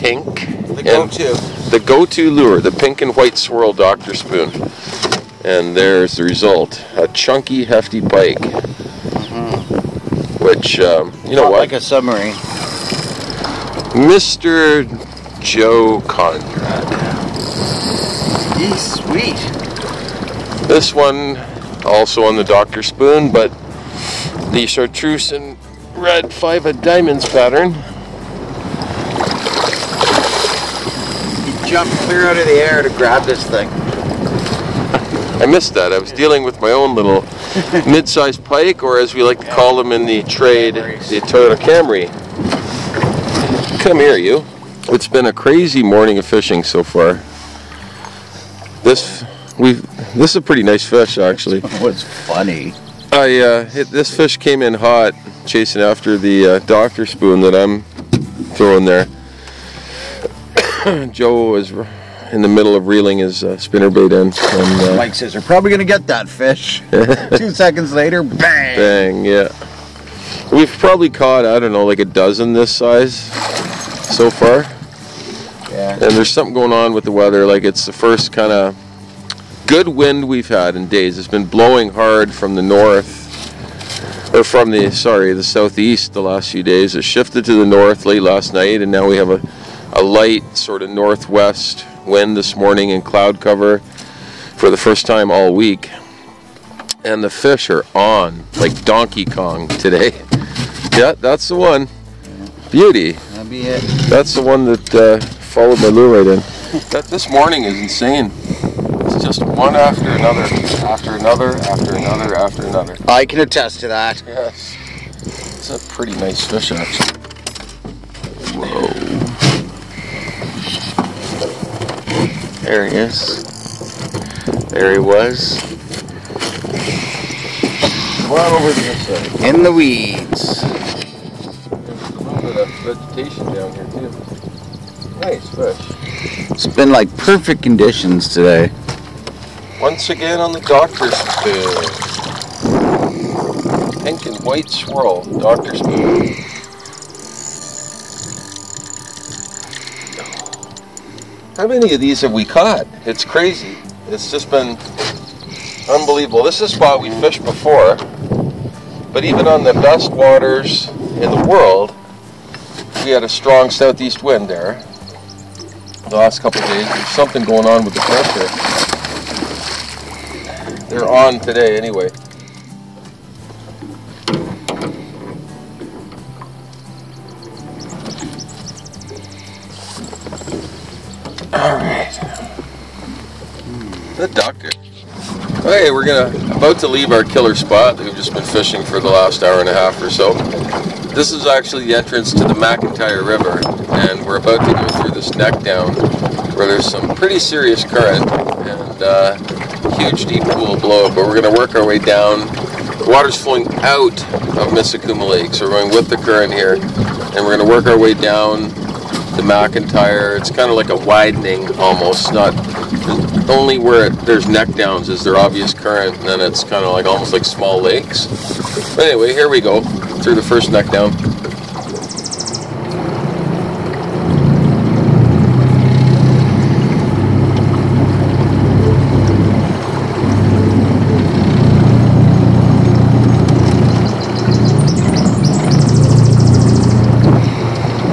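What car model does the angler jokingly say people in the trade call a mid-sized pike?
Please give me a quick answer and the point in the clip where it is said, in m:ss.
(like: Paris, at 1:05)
Toyota Camry, at 0:41.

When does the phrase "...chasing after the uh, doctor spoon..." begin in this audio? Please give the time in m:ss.
0:55.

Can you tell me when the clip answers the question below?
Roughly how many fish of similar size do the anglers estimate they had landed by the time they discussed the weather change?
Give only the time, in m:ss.
1:11.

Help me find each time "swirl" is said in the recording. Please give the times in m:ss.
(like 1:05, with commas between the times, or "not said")
0:03, 2:24.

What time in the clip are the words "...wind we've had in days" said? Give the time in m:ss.
1:19.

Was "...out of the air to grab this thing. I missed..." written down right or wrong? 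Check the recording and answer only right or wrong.
right.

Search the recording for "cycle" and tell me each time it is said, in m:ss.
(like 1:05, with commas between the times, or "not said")
not said.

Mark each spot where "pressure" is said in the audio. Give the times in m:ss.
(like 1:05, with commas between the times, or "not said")
2:47.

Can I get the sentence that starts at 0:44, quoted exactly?
It's been a crazy morning of fishing so far.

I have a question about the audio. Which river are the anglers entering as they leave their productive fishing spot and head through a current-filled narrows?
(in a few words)
McIntyre River.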